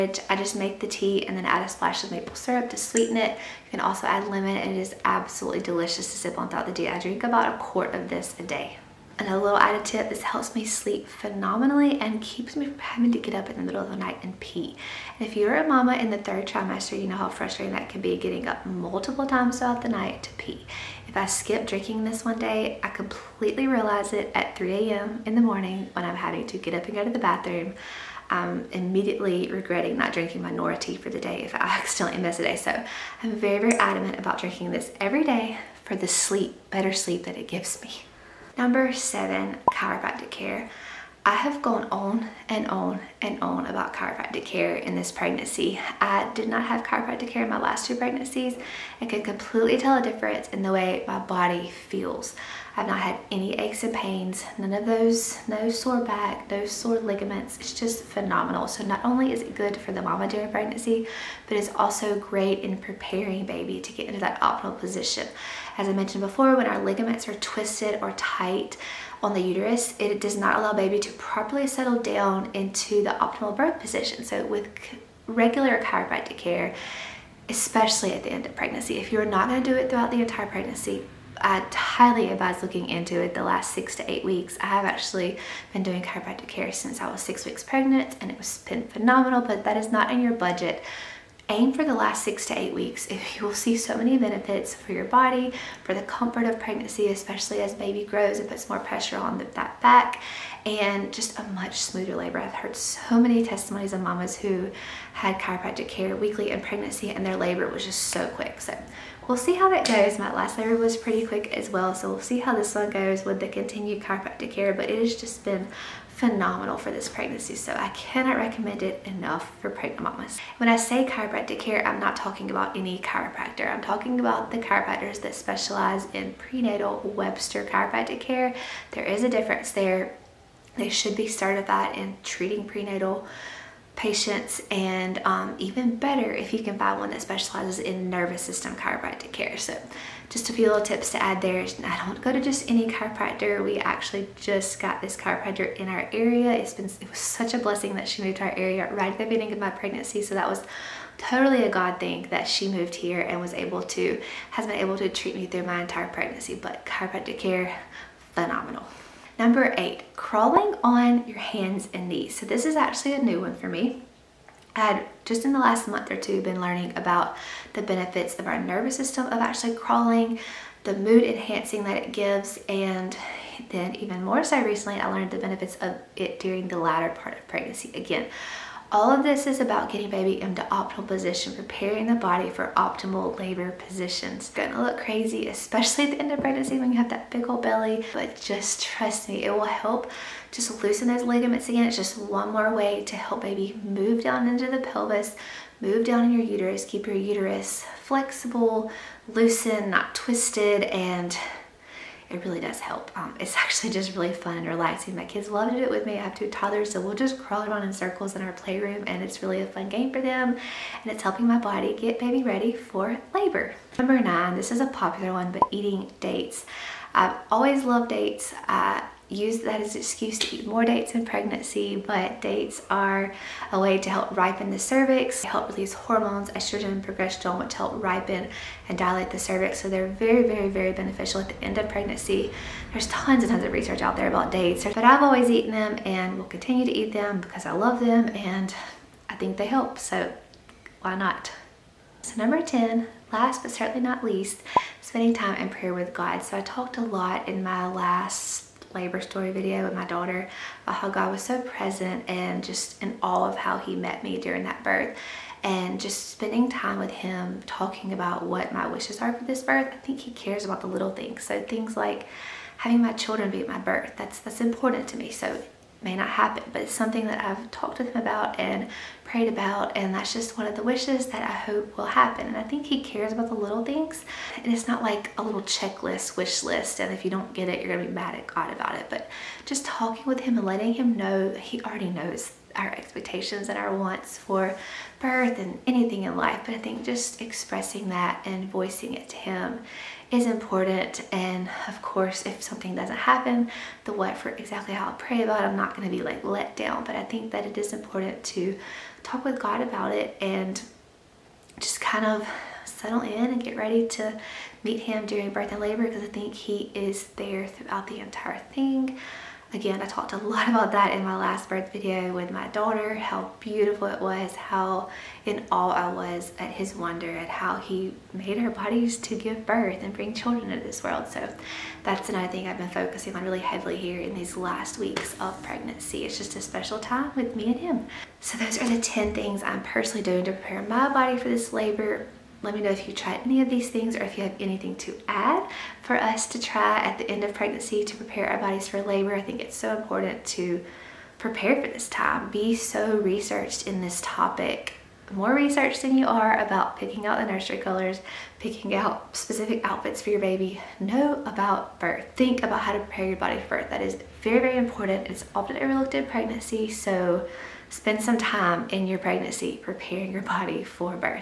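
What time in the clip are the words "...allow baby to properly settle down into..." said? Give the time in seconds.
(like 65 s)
70 s.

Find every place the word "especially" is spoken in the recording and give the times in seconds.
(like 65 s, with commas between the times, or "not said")
77 s, 97 s, 185 s.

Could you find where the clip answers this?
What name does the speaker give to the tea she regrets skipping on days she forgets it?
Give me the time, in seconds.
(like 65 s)
30 s.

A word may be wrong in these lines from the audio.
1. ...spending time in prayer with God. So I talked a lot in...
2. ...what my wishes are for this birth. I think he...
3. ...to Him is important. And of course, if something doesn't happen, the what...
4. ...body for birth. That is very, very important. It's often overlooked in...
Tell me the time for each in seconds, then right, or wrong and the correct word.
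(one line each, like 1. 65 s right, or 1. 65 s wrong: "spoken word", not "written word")
1. 244 s right
2. 258 s right
3. 289 s right
4. 353 s right.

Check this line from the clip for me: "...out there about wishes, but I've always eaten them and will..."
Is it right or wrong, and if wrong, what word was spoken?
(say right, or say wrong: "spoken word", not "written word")
wrong: "dates", not "wishes".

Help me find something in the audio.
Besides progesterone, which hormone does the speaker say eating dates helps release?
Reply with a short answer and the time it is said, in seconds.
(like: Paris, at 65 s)
estrogen, at 226 s.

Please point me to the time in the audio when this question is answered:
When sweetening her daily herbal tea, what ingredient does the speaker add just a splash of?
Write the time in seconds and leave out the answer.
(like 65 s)
2 s.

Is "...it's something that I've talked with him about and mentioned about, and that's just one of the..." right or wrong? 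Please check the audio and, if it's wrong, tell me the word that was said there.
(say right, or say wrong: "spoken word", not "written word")
wrong: "prayed", not "mentioned".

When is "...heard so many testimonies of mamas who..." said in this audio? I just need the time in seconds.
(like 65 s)
102 s.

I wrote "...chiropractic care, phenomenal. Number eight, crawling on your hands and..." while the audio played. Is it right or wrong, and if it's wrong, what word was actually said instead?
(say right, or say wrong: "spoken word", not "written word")
right.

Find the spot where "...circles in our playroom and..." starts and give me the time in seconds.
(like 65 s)
207 s.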